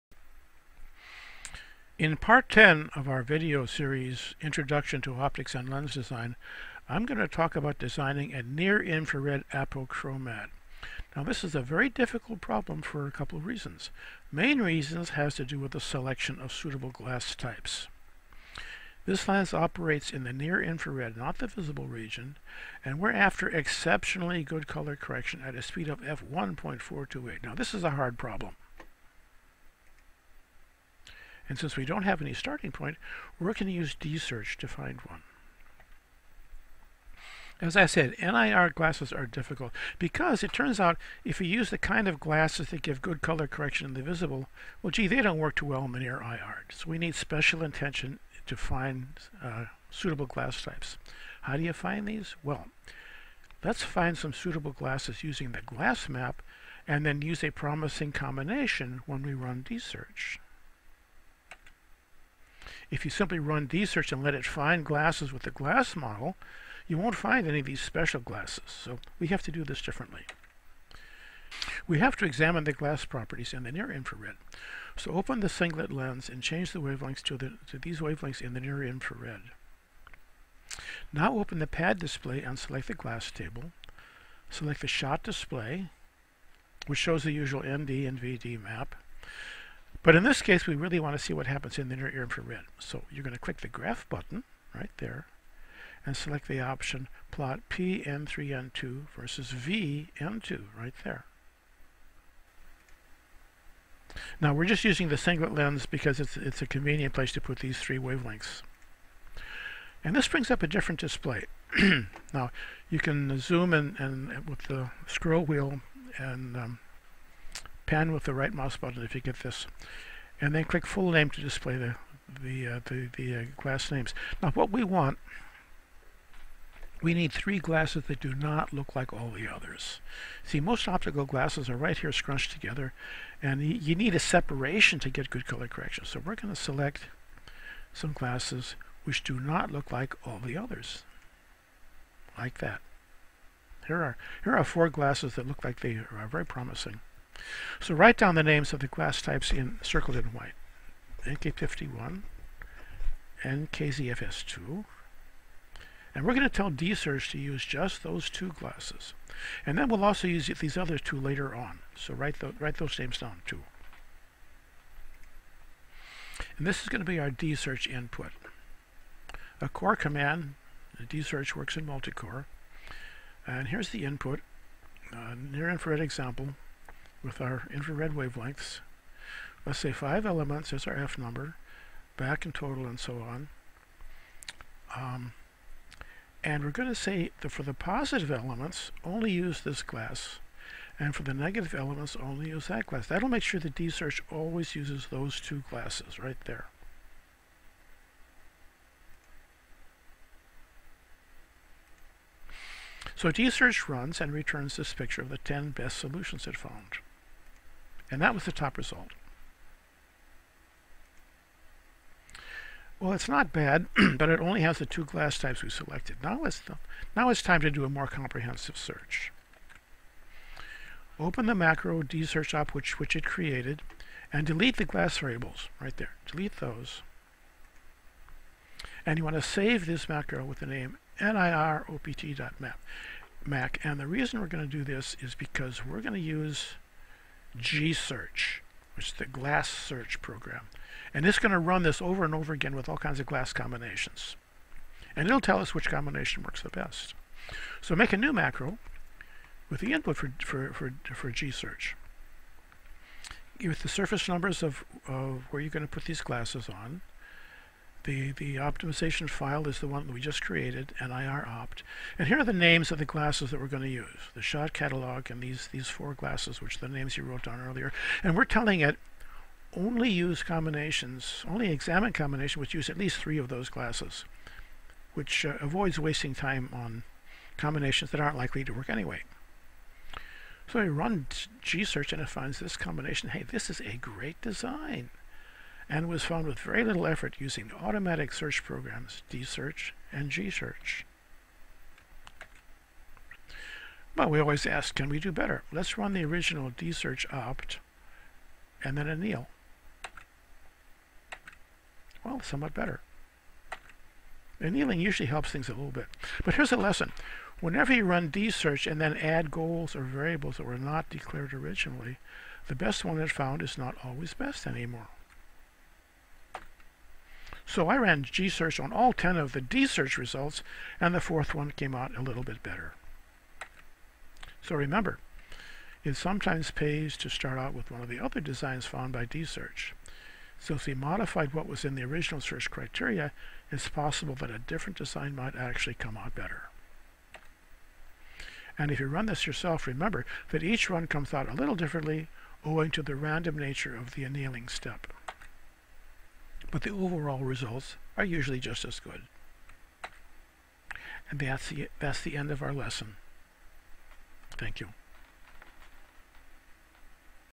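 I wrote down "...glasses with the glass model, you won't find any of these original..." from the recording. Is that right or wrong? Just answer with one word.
wrong.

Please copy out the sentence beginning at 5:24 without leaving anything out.
So remember, it sometimes pays to start out with one of the other designs found by D-search.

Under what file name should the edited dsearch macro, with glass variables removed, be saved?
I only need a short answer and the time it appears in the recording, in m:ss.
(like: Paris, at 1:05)
niropt.map, at 3:51.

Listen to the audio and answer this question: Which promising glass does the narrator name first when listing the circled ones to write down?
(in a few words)
NK51.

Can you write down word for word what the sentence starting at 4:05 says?
And it'll tell us which combination works the best.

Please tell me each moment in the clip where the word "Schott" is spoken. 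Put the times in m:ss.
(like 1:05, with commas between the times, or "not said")
1:24, 4:24.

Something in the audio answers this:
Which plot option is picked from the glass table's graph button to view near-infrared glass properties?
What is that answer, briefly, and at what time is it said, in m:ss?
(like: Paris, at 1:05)
PN3N2 versus VN2, at 1:37.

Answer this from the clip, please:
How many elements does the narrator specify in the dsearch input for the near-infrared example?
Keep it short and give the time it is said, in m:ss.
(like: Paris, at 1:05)
5, at 2:59.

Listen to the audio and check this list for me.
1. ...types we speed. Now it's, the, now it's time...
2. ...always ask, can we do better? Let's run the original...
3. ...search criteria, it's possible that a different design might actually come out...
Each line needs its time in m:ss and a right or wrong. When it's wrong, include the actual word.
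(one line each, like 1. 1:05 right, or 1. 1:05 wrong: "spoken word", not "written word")
1. 3:35 wrong: "selected", not "speed"
2. 4:54 right
3. 5:32 right.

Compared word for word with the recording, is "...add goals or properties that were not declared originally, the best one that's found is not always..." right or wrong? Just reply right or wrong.
wrong.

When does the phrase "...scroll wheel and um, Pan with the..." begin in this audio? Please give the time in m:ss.
1:55.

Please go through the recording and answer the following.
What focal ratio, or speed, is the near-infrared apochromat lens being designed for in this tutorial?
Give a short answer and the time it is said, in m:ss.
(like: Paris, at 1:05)
f/1.428, at 0:26.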